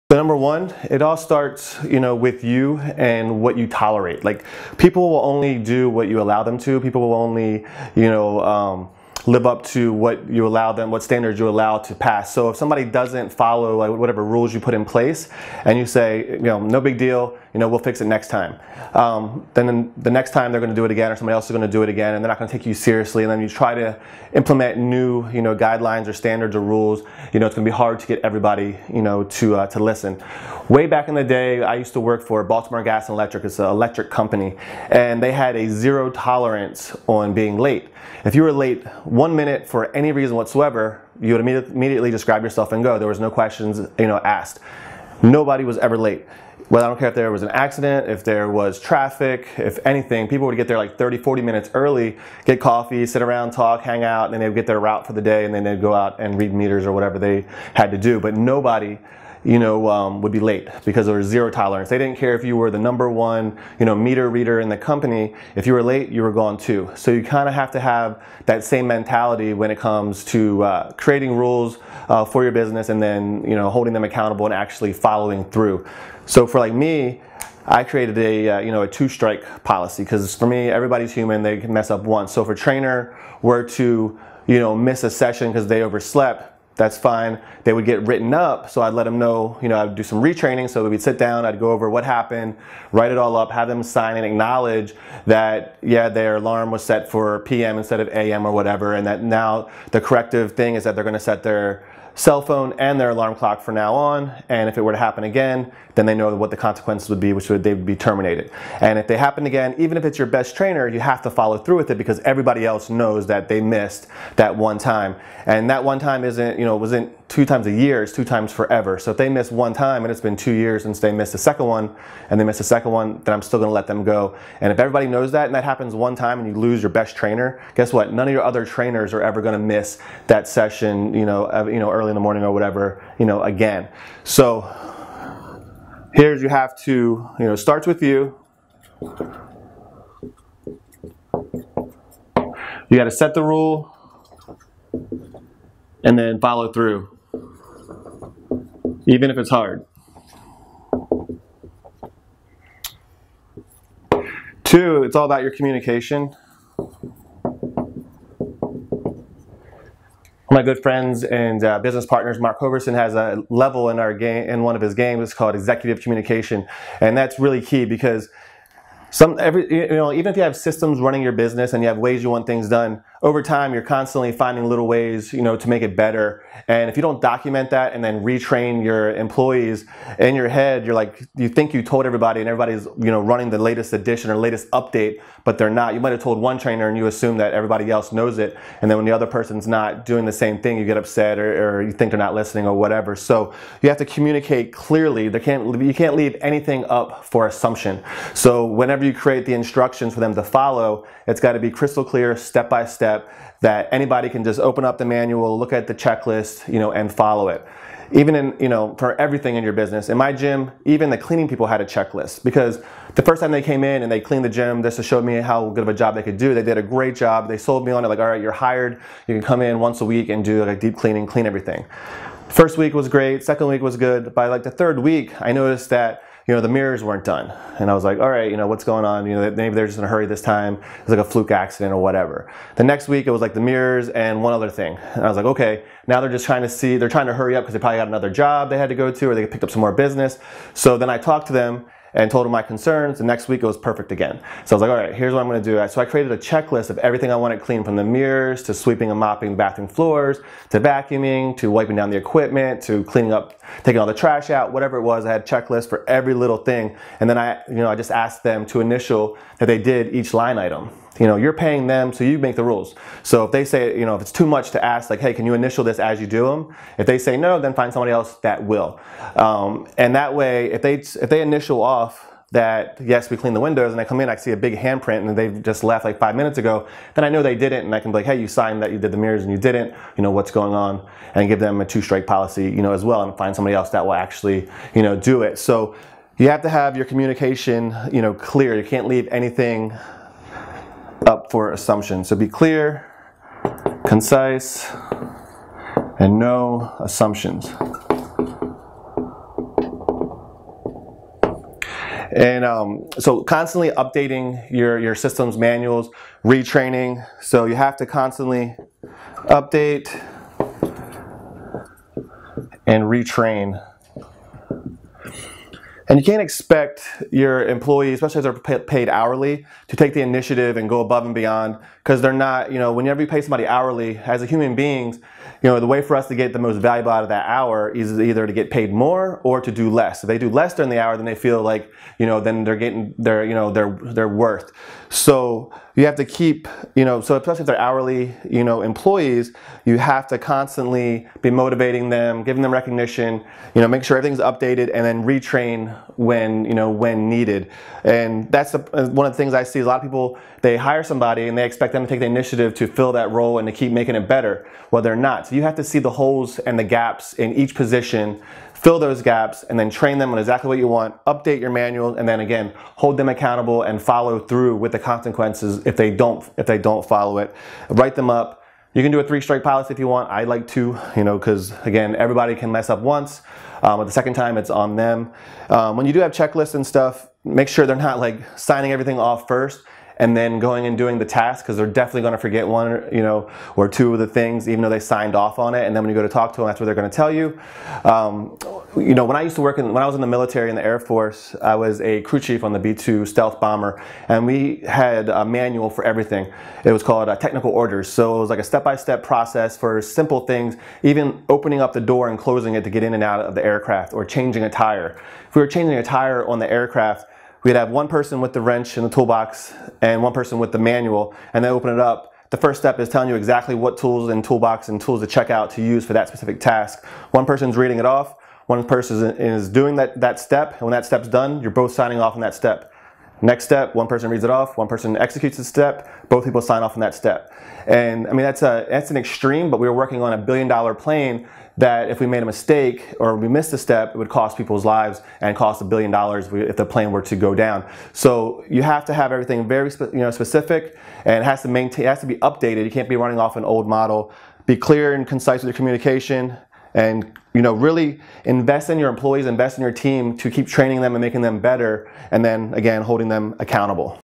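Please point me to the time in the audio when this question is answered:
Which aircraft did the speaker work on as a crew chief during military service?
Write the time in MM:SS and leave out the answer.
06:32.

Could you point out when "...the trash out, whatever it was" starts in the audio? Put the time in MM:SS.
04:14.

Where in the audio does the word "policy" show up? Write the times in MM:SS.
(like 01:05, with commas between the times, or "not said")
01:19, 04:42.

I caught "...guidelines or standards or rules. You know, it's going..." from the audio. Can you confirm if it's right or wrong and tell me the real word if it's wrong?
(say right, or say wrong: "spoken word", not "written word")
right.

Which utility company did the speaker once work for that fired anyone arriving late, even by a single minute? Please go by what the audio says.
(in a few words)
Baltimore Gas and Electric.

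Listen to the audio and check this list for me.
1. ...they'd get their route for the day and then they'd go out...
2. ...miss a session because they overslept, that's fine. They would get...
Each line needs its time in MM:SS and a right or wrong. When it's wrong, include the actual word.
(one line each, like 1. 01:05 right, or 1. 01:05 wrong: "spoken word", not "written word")
1. 00:54 right
2. 01:24 right.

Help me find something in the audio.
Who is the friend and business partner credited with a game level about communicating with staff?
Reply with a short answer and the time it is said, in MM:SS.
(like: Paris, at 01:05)
Mark Hoverson, at 02:42.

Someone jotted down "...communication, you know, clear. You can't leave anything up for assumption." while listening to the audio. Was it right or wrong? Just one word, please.
right.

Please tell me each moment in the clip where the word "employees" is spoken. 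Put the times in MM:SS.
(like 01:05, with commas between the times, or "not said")
02:59, 05:17, 05:38, 07:29.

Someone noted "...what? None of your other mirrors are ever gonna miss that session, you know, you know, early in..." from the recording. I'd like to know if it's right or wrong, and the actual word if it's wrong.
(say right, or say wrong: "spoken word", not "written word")
wrong: "trainers", not "mirrors".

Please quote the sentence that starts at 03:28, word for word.
Even in, you know, for everything in your business.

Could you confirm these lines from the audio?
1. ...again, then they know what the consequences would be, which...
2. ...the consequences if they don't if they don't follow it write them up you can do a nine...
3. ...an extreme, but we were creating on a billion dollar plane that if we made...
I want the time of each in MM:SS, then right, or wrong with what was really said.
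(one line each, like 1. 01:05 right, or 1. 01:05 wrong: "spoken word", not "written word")
1. 01:45 right
2. 06:04 wrong: "three", not "nine"
3. 07:09 wrong: "working", not "creating".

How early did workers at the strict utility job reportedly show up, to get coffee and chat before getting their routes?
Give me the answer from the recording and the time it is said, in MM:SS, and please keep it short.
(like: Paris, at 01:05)
30, 40 minutes, at 00:50.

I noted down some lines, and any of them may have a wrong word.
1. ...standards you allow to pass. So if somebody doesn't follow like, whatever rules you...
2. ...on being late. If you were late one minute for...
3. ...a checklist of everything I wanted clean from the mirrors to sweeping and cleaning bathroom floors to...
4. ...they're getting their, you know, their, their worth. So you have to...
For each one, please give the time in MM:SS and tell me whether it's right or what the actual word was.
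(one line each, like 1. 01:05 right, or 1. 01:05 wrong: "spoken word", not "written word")
1. 00:11 right
2. 00:37 right
3. 04:06 wrong: "mopping", not "cleaning"
4. 05:32 right.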